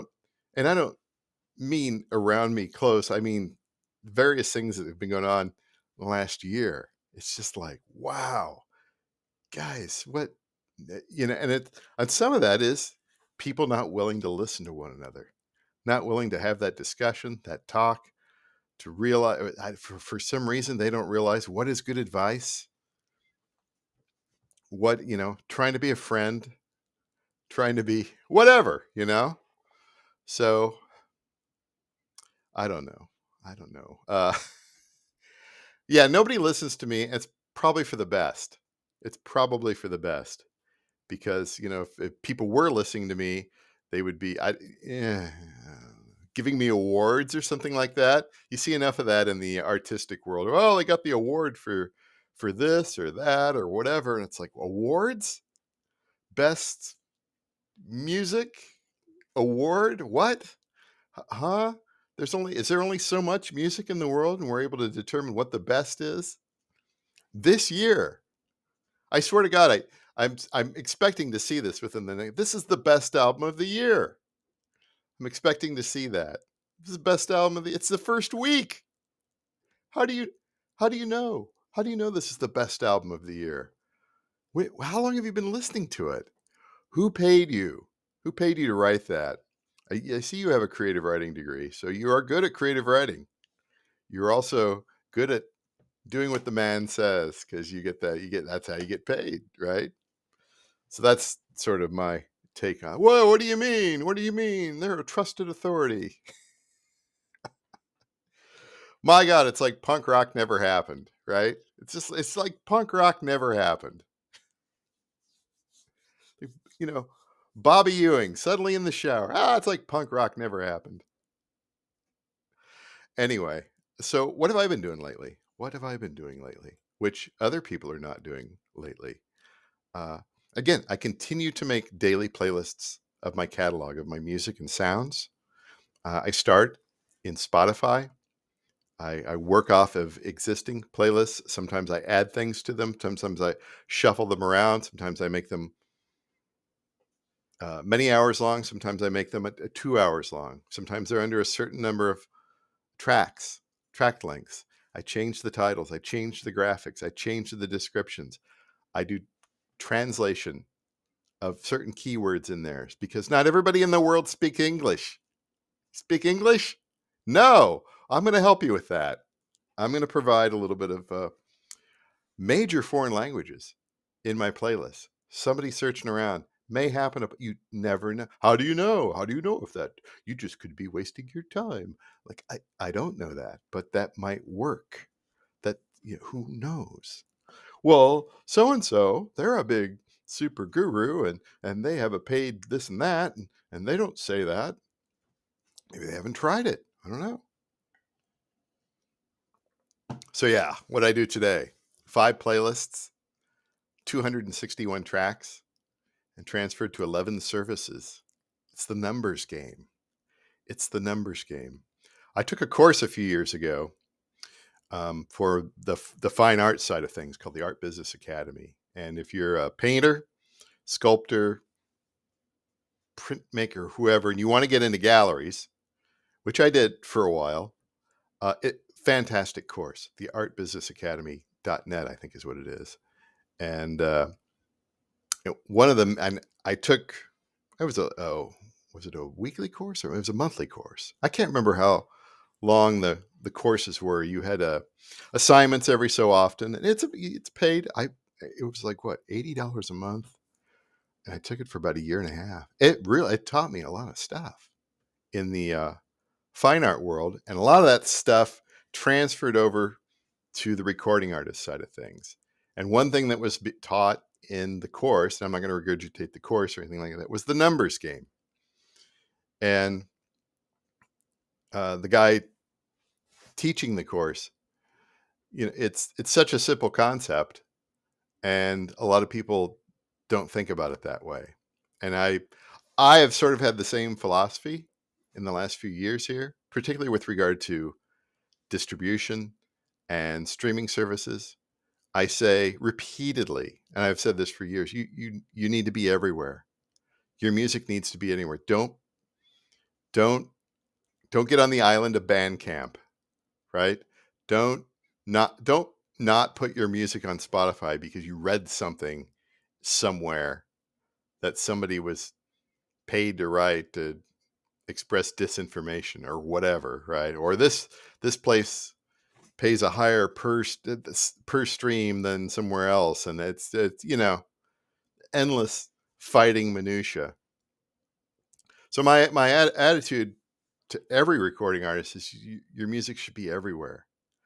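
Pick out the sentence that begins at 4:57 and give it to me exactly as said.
Your music needs to be anywhere.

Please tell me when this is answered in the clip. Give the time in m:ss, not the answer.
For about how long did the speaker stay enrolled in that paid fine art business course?
4:11.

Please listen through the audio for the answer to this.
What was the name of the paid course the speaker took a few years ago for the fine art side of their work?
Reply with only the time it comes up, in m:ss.
3:37.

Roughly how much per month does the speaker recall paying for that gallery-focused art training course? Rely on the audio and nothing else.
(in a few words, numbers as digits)
$80.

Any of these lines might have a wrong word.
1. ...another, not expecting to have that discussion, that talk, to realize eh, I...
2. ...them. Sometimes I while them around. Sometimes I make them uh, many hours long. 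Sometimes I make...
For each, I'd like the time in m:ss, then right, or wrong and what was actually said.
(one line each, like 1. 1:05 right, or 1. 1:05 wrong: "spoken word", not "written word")
1. 0:14 wrong: "willing", not "expecting"
2. 2:22 wrong: "shuffle", not "while".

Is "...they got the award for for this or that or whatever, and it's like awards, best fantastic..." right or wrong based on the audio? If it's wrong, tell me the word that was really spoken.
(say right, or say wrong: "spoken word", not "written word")
wrong: "music", not "fantastic".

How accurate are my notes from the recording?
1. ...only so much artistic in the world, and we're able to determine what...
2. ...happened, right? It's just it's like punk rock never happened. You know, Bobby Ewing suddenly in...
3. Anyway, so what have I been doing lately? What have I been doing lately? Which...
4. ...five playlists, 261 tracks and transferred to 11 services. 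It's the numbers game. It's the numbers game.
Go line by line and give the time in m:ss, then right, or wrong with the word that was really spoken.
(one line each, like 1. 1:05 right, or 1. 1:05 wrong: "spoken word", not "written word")
1. 1:02 wrong: "music", not "artistic"
2. 1:50 right
3. 2:03 right
4. 3:22 right.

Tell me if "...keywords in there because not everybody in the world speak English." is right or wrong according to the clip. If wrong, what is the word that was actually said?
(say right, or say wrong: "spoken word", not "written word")
right.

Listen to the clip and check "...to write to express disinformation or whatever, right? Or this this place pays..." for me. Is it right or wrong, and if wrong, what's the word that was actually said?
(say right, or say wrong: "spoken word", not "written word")
right.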